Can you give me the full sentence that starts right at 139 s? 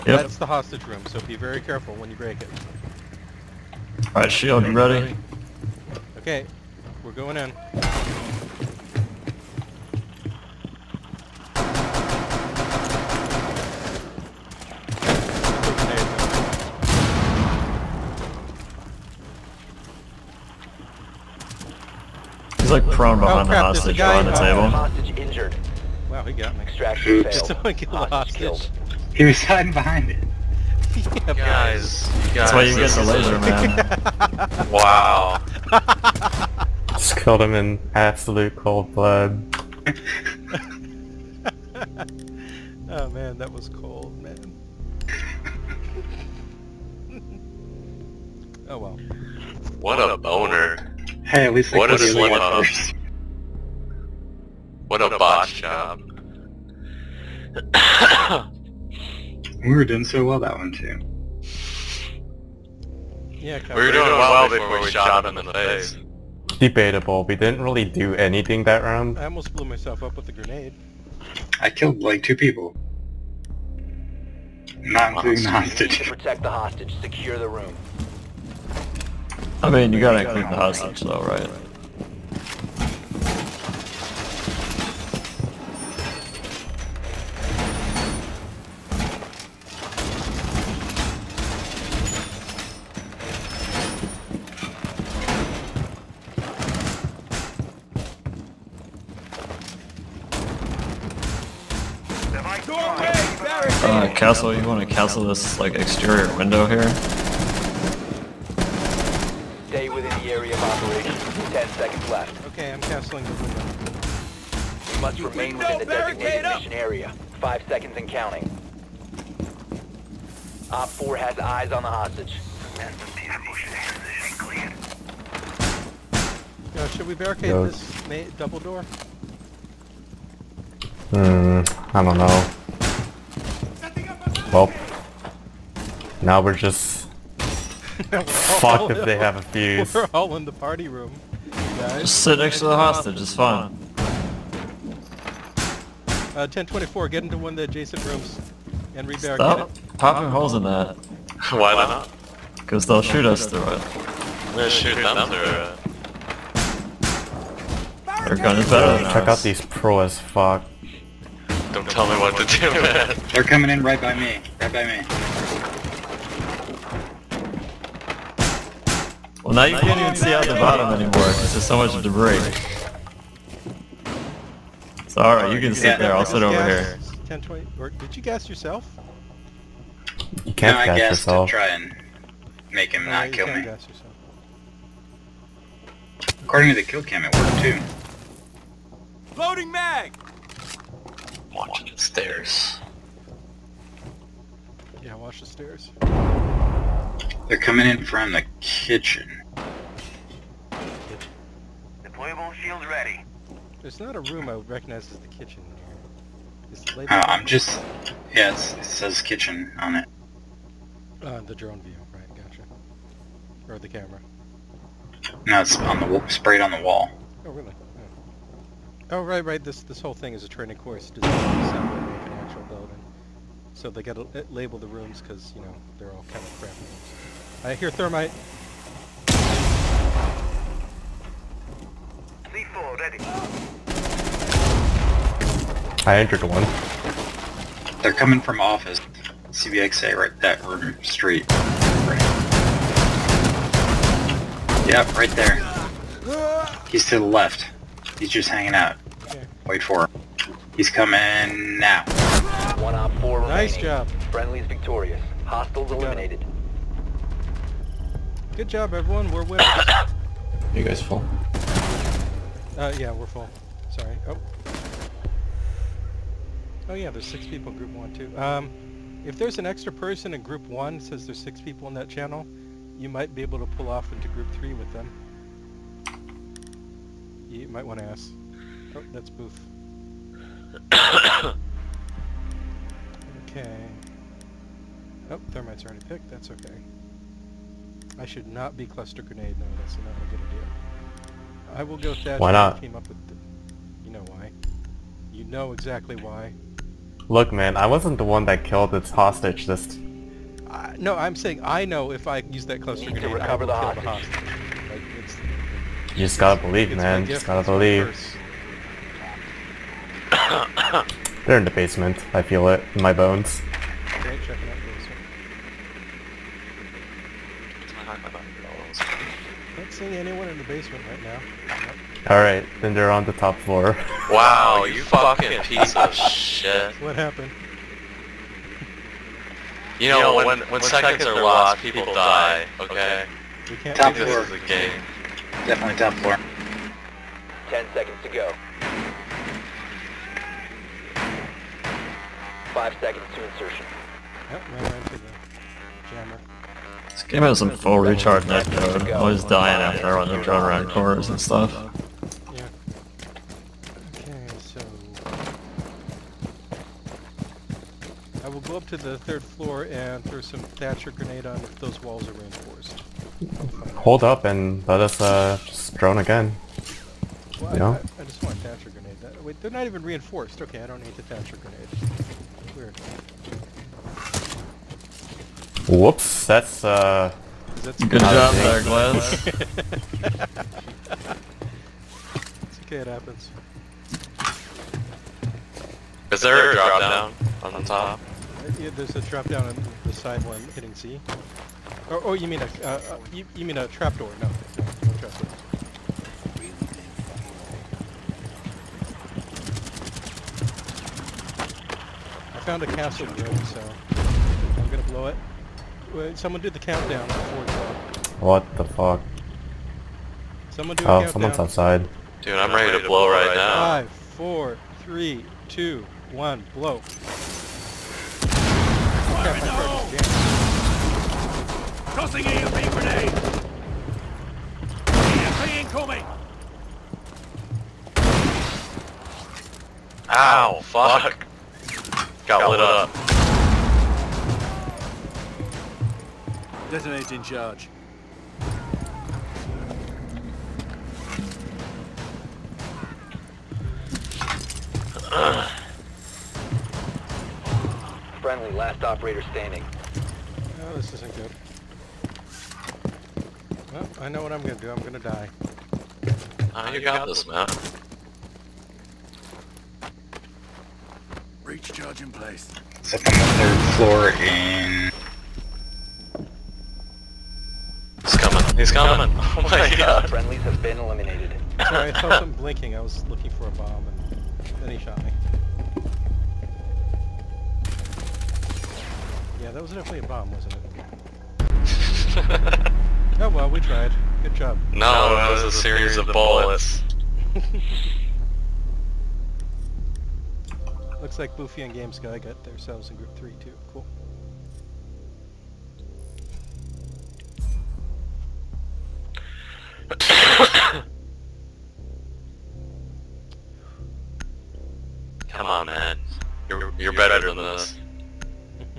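We're all in the party room guys.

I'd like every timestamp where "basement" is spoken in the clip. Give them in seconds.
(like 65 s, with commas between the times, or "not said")
311 s, 320 s.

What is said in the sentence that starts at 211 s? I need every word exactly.
Uh, the drone view, right, gotcha.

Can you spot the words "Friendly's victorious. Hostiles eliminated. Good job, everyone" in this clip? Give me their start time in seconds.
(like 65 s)
254 s.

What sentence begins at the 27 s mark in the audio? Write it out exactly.
Did someone kill hostage the hostage?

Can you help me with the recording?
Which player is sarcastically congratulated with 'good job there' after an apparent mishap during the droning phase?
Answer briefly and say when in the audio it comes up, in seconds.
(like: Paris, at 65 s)
Glaz, at 378 s.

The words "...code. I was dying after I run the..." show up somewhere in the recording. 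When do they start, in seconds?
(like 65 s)
348 s.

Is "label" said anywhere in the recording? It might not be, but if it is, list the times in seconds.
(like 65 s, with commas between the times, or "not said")
224 s.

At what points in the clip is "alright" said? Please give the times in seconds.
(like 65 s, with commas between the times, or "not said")
4 s, 175 s, 322 s.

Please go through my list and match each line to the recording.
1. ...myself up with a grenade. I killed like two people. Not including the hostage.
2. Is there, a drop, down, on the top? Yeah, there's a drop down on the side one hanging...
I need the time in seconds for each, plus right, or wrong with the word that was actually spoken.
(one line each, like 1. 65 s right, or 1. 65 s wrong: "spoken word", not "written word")
1. 69 s right
2. 386 s wrong: "hitting", not "hanging".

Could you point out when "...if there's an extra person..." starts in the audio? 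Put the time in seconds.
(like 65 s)
269 s.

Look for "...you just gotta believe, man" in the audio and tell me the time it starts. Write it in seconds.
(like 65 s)
306 s.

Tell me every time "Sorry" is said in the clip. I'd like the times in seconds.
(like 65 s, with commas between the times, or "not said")
263 s, 471 s.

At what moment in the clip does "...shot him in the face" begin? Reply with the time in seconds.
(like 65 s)
64 s.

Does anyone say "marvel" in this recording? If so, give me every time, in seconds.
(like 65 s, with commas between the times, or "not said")
not said.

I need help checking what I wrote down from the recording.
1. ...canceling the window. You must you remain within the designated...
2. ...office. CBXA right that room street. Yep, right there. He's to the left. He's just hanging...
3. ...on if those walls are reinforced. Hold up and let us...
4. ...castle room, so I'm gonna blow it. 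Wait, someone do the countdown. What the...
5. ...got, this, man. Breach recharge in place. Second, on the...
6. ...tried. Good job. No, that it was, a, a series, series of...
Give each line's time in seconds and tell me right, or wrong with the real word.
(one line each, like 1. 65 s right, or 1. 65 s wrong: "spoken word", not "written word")
1. 112 s right
2. 238 s right
3. 361 s right
4. 402 s right
5. 456 s wrong: "charge", not "recharge"
6. 483 s right.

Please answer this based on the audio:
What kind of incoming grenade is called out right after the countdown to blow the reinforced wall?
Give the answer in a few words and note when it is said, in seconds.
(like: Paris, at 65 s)
EMP, at 425 s.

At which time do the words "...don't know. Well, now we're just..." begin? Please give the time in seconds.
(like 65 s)
132 s.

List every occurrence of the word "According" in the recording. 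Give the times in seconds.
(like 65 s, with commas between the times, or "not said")
186 s.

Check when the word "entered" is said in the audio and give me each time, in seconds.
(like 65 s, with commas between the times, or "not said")
236 s.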